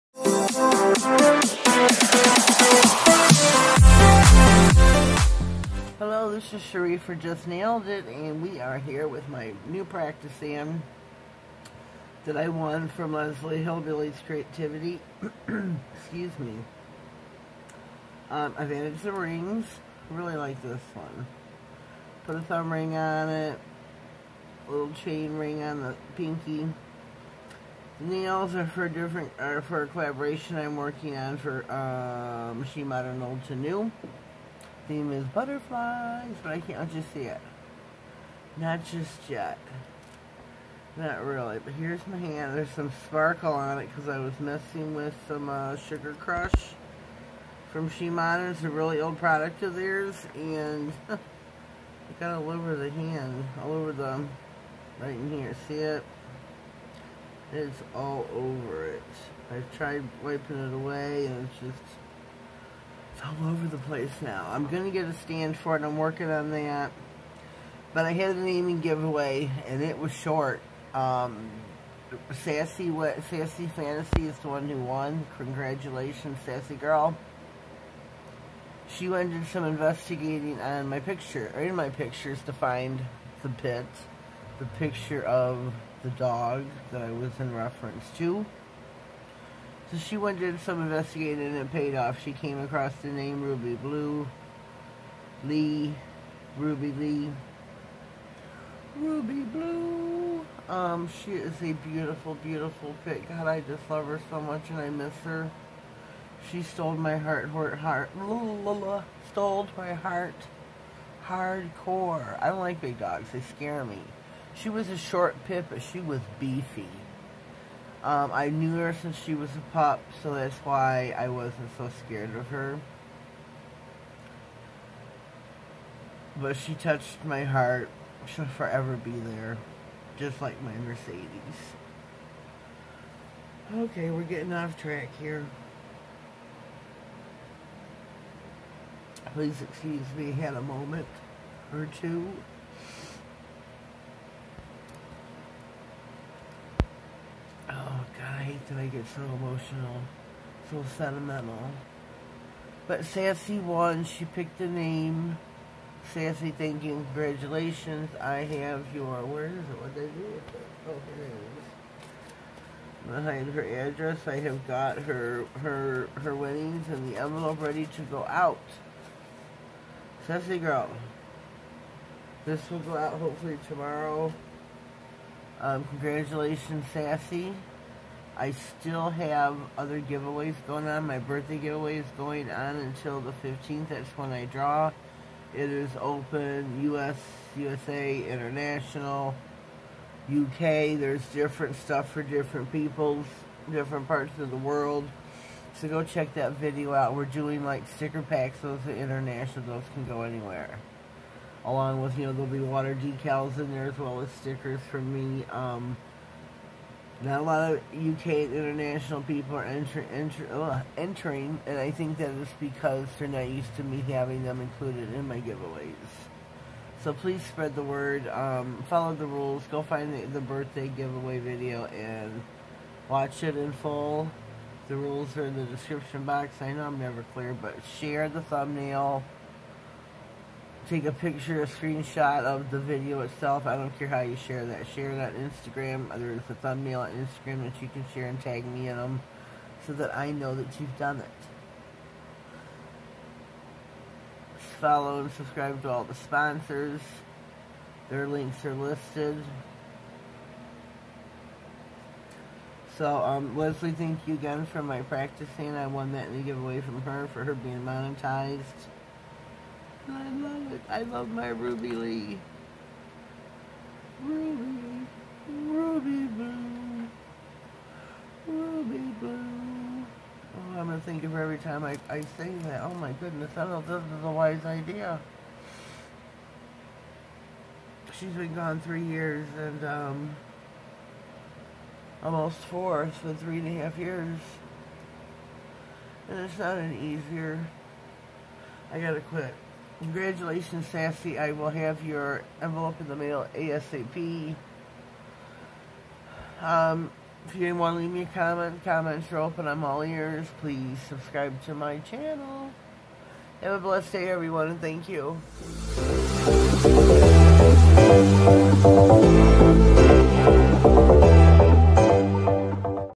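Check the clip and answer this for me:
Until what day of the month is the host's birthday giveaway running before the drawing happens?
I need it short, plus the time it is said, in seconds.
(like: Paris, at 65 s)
15th, at 183 s.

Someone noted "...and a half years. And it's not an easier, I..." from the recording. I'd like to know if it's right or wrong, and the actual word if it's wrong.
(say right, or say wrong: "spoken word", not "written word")
right.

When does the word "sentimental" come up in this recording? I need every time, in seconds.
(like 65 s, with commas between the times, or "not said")
150 s.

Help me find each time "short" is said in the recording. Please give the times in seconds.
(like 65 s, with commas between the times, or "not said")
70 s, 114 s.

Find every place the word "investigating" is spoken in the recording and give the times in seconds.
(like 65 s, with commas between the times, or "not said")
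79 s, 90 s.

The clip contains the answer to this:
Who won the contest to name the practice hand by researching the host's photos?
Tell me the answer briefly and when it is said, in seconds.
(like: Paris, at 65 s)
Sassy Fantasy, at 73 s.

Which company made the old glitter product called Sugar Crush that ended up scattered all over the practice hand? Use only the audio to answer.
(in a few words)
Shimano.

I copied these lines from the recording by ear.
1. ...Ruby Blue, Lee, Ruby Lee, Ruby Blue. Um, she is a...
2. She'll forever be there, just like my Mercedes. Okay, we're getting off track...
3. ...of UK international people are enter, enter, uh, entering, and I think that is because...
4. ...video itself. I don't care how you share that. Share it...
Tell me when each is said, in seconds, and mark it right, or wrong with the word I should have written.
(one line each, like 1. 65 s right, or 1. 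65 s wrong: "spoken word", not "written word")
1. 93 s right
2. 128 s right
3. 207 s right
4. 232 s right.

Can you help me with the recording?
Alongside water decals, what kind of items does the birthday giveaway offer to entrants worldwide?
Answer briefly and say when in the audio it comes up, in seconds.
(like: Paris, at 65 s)
Sticker packs, at 197 s.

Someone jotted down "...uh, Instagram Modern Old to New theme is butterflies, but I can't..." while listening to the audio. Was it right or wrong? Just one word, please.
wrong.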